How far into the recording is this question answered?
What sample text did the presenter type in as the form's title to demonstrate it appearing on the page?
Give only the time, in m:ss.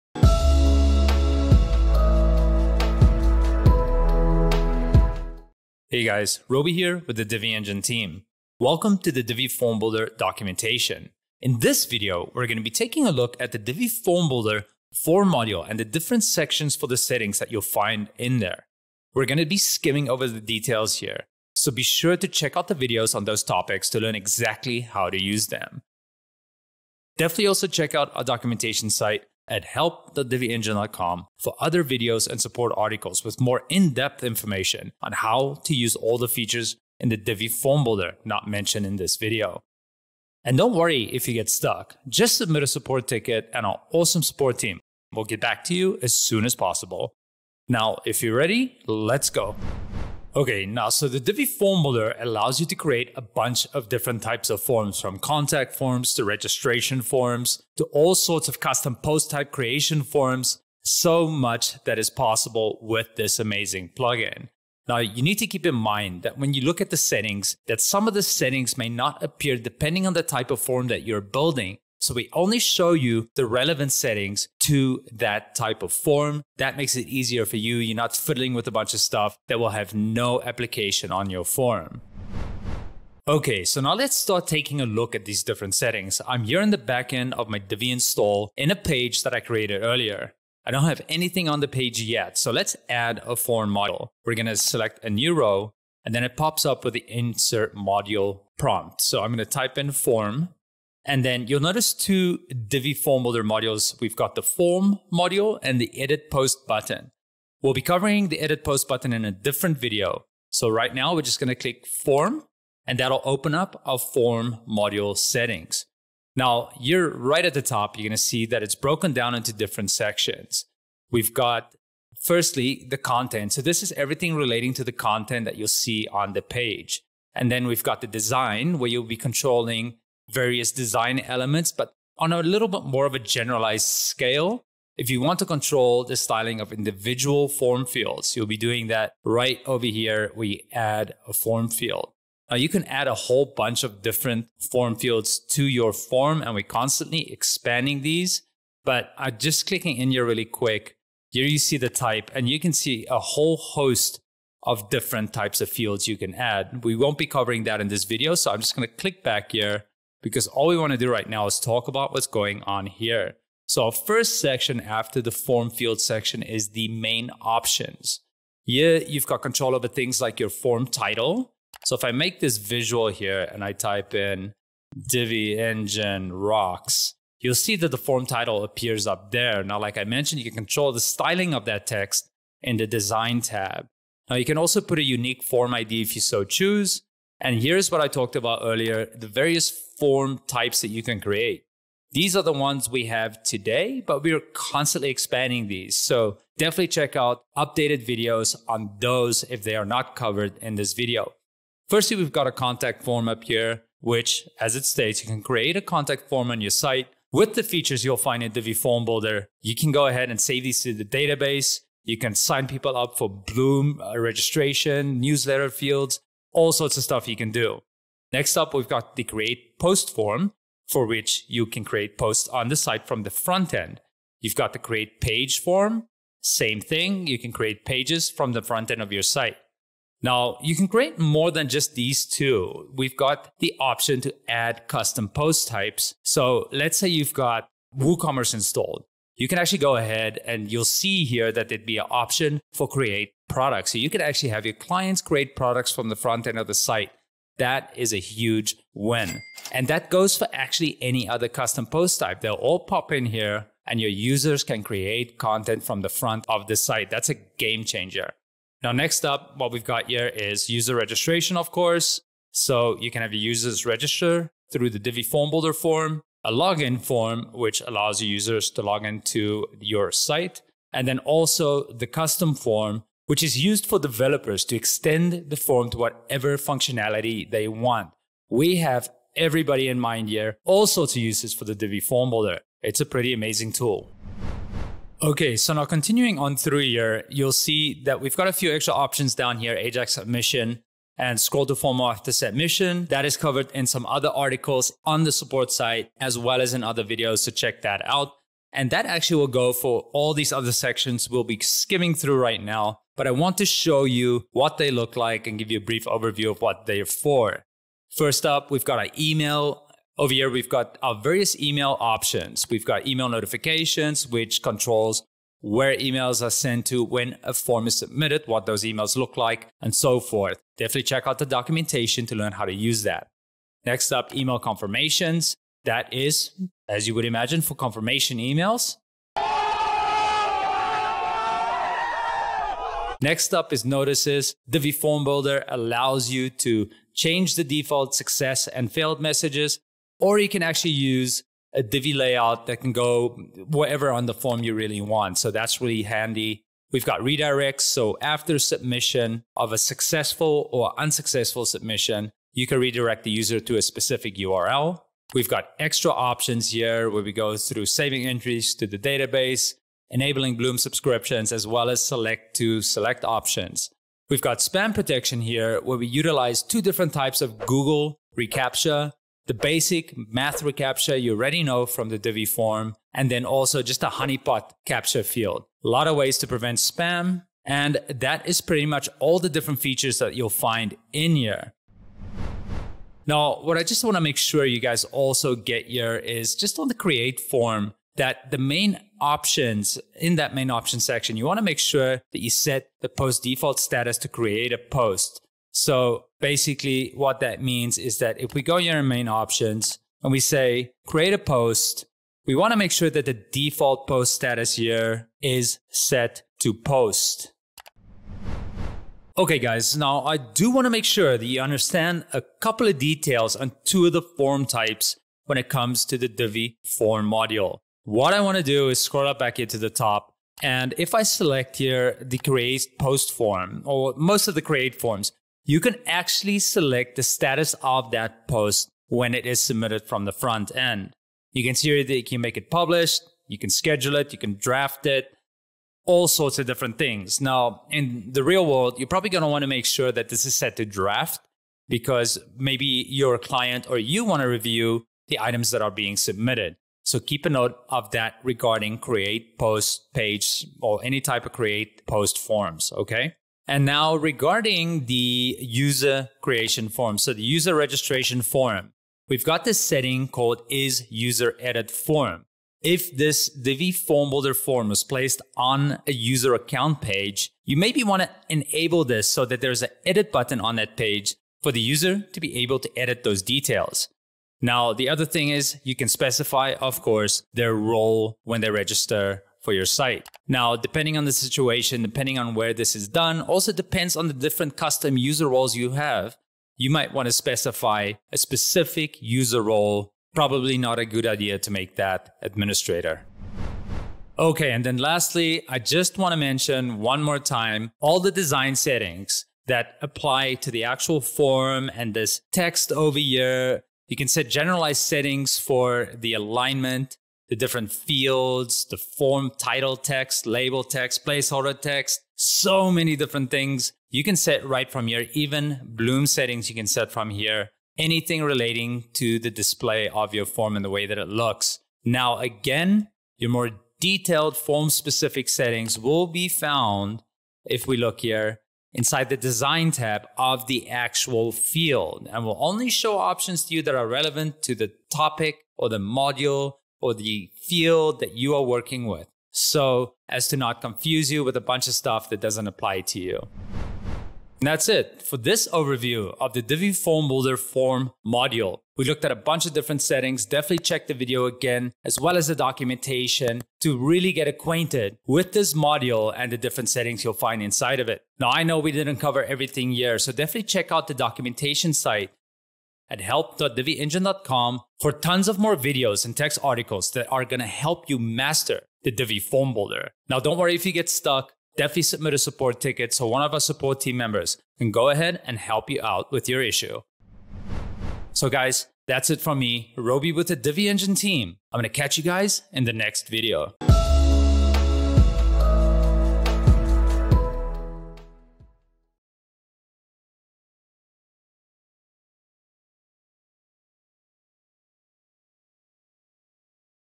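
2:55.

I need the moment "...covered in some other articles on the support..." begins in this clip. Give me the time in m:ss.
4:53.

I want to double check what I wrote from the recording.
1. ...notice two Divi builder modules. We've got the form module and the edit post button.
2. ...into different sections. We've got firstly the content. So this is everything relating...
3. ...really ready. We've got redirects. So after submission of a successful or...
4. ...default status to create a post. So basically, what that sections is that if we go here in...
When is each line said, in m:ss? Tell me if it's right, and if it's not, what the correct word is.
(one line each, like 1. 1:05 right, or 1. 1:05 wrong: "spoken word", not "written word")
1. 1:41 right
2. 1:59 right
3. 5:45 wrong: "handy", not "ready"
4. 6:33 wrong: "means", not "sections".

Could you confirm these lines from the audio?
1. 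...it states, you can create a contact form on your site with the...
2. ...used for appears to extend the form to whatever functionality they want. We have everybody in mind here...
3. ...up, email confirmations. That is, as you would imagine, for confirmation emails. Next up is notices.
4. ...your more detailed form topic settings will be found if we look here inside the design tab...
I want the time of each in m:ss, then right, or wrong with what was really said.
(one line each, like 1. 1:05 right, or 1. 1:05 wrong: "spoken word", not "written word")
1. 3:24 right
2. 4:33 wrong: "developers", not "appears"
3. 5:24 right
4. 8:43 wrong: "specific", not "topic".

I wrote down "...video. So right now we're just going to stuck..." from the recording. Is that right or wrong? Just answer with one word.
wrong.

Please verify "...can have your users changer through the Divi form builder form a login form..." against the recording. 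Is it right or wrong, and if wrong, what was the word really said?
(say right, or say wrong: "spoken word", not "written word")
wrong: "register", not "changer".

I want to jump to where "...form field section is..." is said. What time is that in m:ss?
2:45.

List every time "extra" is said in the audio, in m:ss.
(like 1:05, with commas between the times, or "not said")
4:48, 5:55.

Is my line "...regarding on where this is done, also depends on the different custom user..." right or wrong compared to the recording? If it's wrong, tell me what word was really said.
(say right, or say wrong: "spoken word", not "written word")
wrong: "depending", not "regarding".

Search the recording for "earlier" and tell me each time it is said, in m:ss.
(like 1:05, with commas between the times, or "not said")
1:29, 3:08.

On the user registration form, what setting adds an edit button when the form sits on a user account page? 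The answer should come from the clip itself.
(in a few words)
Is user edit form.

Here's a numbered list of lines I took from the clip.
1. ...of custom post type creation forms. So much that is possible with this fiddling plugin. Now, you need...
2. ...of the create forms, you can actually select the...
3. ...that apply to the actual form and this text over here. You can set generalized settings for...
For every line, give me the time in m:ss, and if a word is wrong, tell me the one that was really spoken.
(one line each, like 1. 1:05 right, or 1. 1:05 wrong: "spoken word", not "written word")
1. 0:58 wrong: "amazing", not "fiddling"
2. 7:04 right
3. 8:19 right.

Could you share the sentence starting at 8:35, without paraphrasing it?
Even bloom settings you can set from here.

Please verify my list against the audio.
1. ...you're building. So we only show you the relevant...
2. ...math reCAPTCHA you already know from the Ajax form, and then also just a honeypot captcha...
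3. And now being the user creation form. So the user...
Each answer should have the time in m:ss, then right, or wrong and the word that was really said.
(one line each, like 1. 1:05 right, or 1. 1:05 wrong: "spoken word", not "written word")
1. 1:11 right
2. 6:10 wrong: "Divi", not "Ajax"
3. 7:33 wrong: "regarding", not "being".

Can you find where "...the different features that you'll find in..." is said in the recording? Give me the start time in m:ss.
6:19.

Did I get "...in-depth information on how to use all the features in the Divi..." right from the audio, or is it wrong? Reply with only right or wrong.
right.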